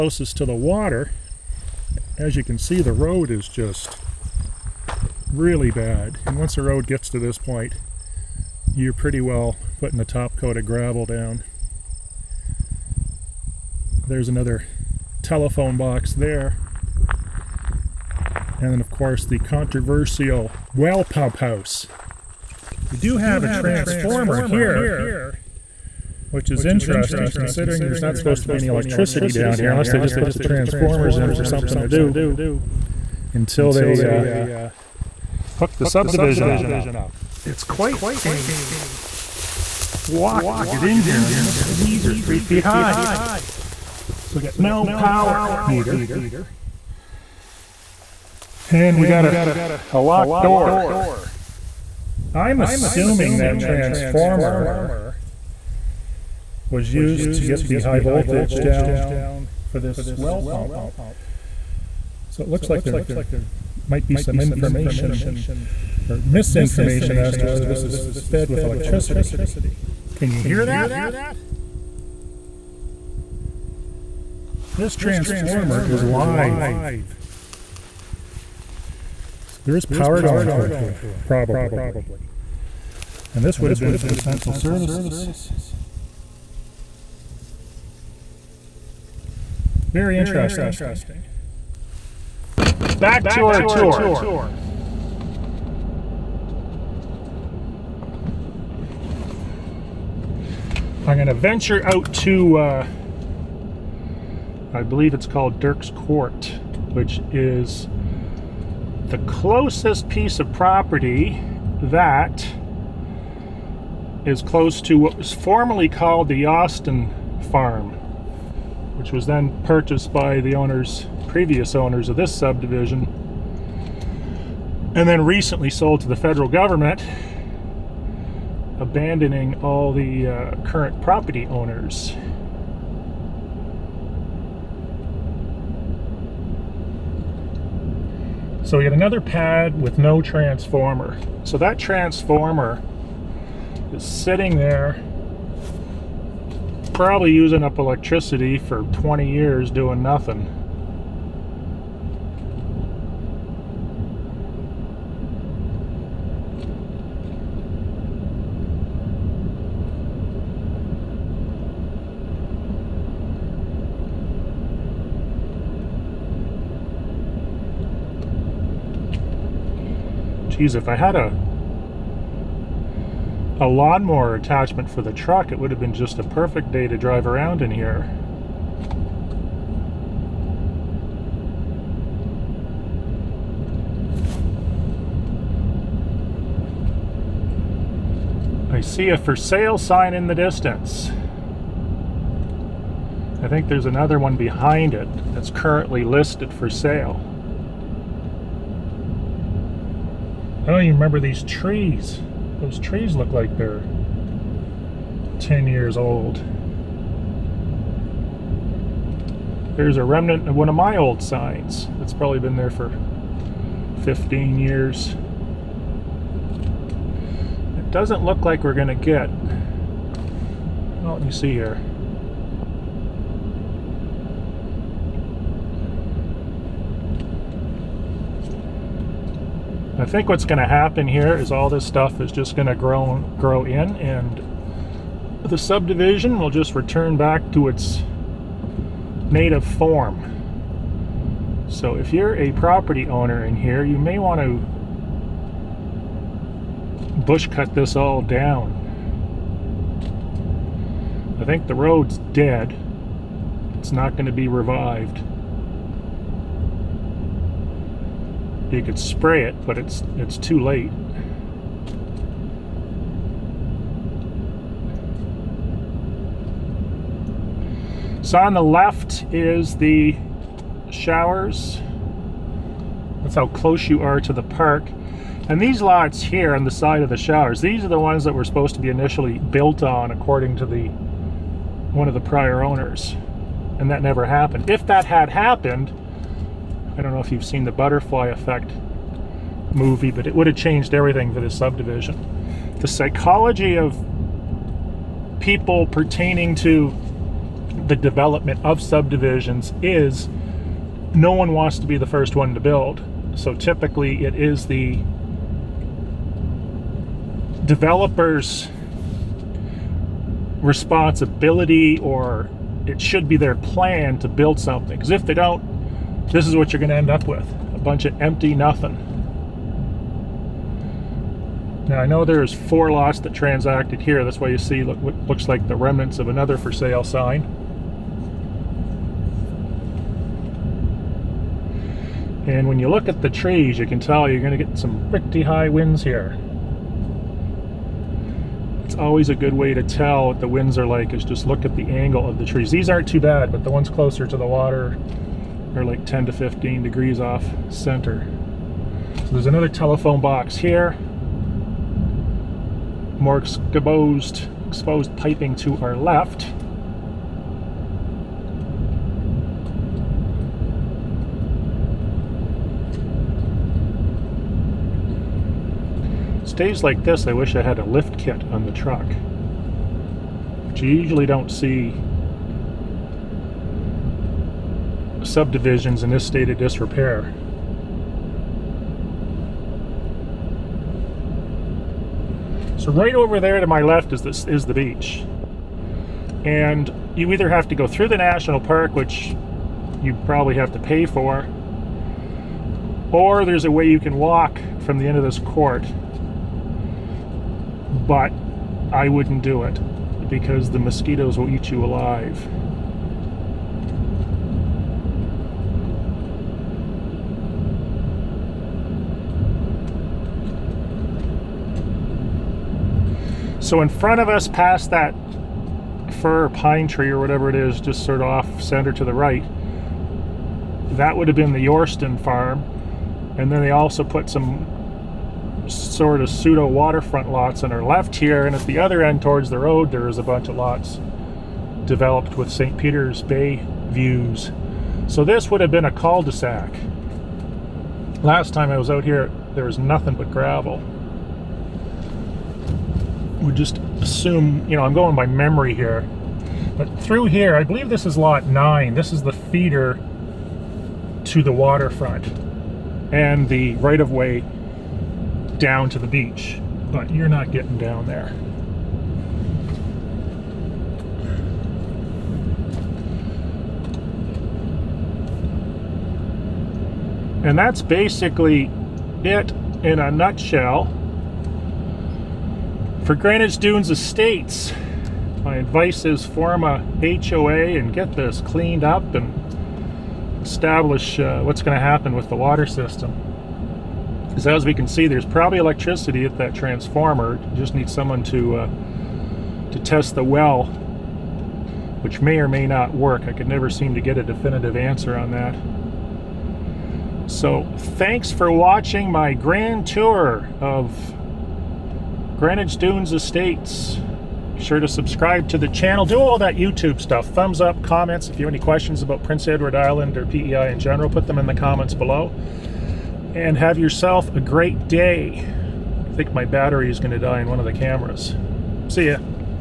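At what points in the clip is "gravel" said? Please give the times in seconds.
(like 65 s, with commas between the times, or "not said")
10 s, 440 s.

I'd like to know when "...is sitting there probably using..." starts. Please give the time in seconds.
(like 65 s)
143 s.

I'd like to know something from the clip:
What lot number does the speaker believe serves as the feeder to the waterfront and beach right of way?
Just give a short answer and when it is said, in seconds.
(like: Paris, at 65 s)
Lot 9, at 448 s.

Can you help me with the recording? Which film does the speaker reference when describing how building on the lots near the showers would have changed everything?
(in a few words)
The Butterfly Effect.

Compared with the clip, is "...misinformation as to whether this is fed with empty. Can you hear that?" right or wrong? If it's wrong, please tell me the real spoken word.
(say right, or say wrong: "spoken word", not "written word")
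wrong: "electricity", not "empty".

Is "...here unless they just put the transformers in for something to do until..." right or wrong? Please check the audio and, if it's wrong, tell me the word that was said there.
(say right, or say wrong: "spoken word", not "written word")
right.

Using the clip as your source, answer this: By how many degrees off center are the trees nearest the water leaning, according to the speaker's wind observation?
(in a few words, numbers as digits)
10 to 15 degrees.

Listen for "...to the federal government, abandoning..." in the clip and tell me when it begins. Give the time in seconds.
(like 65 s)
126 s.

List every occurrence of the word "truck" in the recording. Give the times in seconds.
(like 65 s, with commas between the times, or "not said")
175 s, 368 s.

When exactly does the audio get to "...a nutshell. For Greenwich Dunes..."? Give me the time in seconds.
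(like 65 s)
469 s.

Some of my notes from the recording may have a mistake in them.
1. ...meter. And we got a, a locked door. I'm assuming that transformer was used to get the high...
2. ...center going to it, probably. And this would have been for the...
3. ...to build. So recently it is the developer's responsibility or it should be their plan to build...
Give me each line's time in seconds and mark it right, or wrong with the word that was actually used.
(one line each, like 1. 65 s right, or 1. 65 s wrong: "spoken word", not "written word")
1. 45 s right
2. 79 s wrong: "power", not "center"
3. 302 s wrong: "typically", not "recently".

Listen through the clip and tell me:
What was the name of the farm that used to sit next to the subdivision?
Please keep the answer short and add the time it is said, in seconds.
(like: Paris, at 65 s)
Austin Farm, at 116 s.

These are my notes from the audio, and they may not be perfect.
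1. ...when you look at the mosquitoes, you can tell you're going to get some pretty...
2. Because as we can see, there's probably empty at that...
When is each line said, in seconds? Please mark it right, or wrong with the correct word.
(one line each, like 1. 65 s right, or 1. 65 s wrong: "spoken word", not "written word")
1. 332 s wrong: "trees", not "mosquitoes"
2. 484 s wrong: "electricity", not "empty".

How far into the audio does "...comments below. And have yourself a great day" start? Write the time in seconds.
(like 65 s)
511 s.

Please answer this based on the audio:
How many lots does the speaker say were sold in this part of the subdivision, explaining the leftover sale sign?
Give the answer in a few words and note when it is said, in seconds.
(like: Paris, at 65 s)
4, at 322 s.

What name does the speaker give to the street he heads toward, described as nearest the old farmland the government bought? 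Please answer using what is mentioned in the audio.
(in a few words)
Dirk's Court.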